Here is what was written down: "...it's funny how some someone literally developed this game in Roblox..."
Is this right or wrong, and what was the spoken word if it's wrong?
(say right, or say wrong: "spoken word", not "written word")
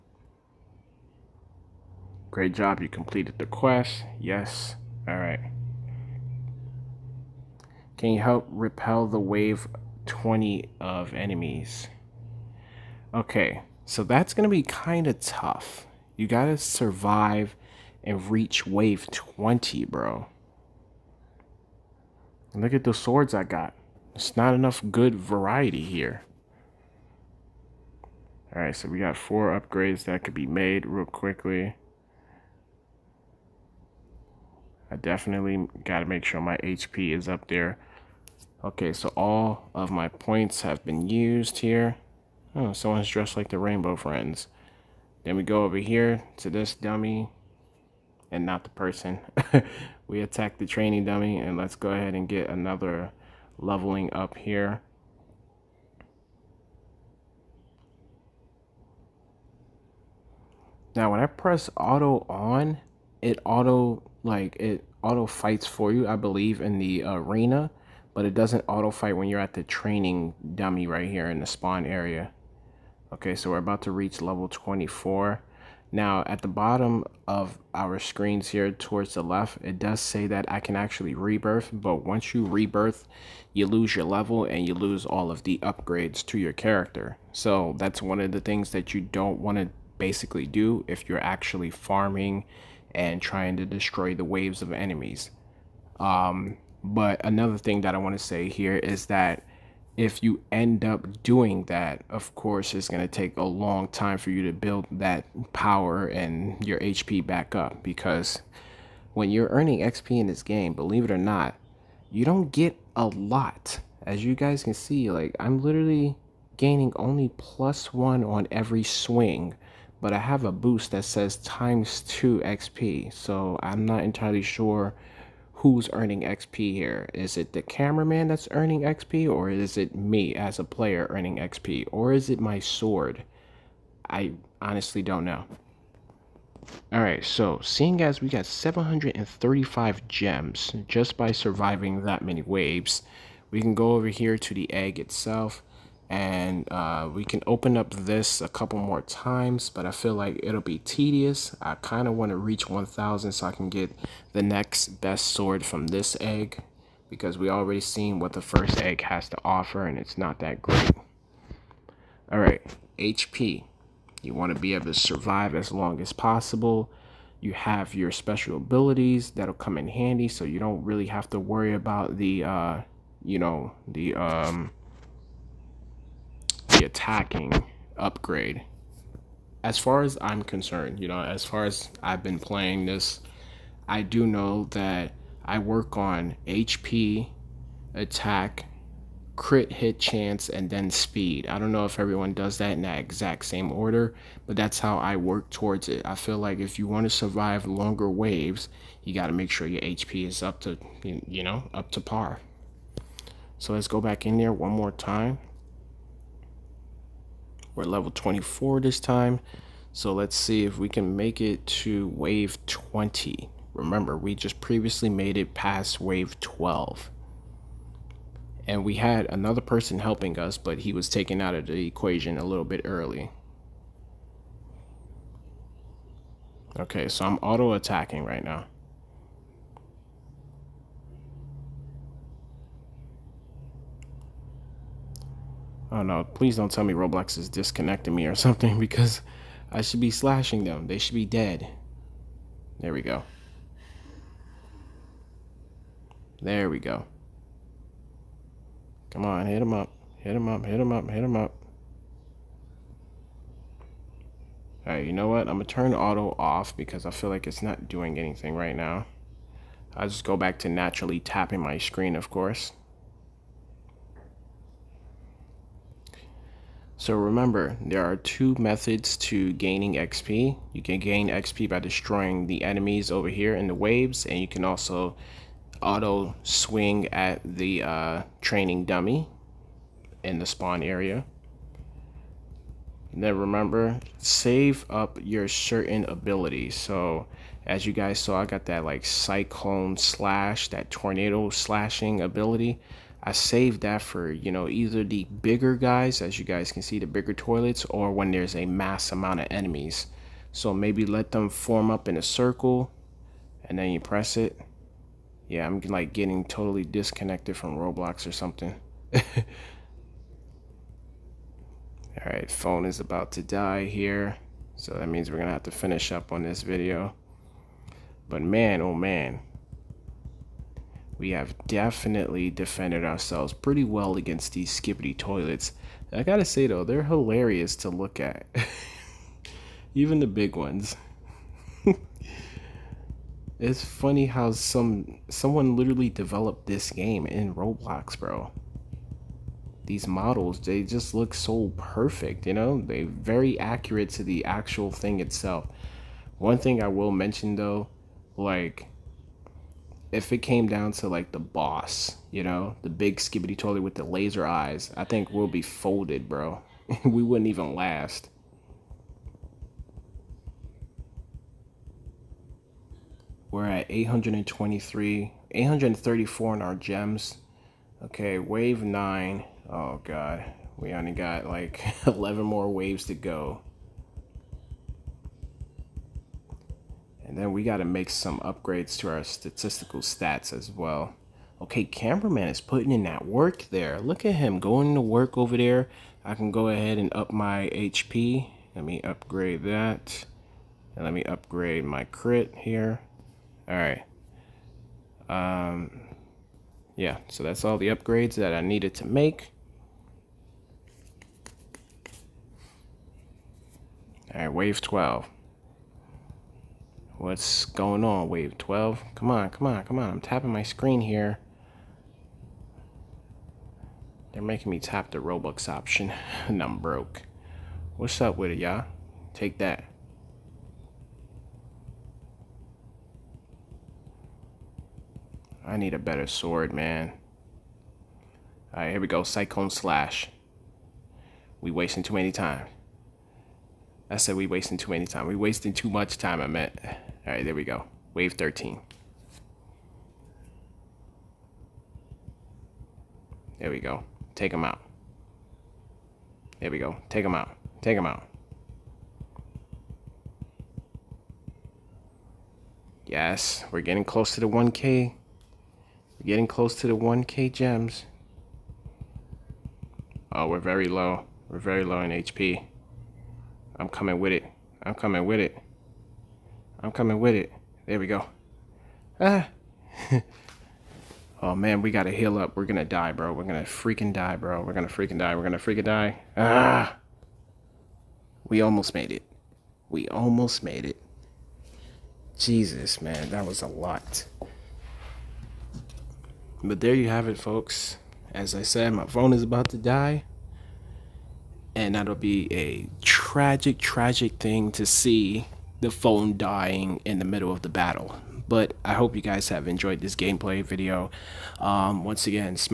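right.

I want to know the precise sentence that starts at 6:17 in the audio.
And then we got to make some upgrades to our statistical stats as well.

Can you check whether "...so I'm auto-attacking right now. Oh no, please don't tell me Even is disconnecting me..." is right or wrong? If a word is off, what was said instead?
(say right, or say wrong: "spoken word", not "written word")
wrong: "Roblox", not "Even".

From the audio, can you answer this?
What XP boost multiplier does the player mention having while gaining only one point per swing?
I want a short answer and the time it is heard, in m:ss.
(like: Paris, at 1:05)
times two, at 2:01.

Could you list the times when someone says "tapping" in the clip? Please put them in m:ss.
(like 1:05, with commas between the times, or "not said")
4:21, 6:50.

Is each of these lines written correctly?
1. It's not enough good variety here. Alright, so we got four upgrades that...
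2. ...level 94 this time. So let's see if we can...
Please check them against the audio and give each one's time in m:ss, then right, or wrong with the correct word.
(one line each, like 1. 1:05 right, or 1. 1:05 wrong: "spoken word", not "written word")
1. 0:24 right
2. 3:27 wrong: "24", not "94".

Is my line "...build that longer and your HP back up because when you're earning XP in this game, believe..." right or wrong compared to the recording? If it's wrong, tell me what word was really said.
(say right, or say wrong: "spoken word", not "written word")
wrong: "power", not "longer".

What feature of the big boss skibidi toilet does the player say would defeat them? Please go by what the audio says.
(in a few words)
laser eyes.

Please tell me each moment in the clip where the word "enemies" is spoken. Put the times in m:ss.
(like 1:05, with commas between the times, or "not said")
0:11, 1:34, 4:32, 4:59.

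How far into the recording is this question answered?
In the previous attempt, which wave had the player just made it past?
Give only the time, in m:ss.
3:35.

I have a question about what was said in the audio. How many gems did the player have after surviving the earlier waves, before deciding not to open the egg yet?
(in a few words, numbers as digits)
735.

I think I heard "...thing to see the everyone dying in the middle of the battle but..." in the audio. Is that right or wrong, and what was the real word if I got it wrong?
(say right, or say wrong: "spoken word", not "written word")
wrong: "phone", not "everyone".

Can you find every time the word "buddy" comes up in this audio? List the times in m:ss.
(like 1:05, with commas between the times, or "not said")
not said.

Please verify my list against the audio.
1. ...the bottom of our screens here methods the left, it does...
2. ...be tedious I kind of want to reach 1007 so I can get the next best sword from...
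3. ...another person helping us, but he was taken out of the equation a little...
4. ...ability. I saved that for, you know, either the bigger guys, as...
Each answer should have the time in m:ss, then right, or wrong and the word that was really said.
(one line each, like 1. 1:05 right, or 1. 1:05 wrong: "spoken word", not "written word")
1. 1:16 wrong: "towards", not "methods"
2. 2:30 wrong: "1000", not "1007"
3. 3:39 right
4. 4:52 right.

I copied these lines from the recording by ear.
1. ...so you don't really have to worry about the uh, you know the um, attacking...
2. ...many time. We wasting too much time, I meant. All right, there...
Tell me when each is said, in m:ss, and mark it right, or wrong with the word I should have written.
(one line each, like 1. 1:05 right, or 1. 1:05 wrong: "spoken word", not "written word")
1. 2:50 right
2. 7:14 right.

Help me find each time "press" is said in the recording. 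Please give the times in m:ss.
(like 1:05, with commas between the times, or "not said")
1:01, 5:03.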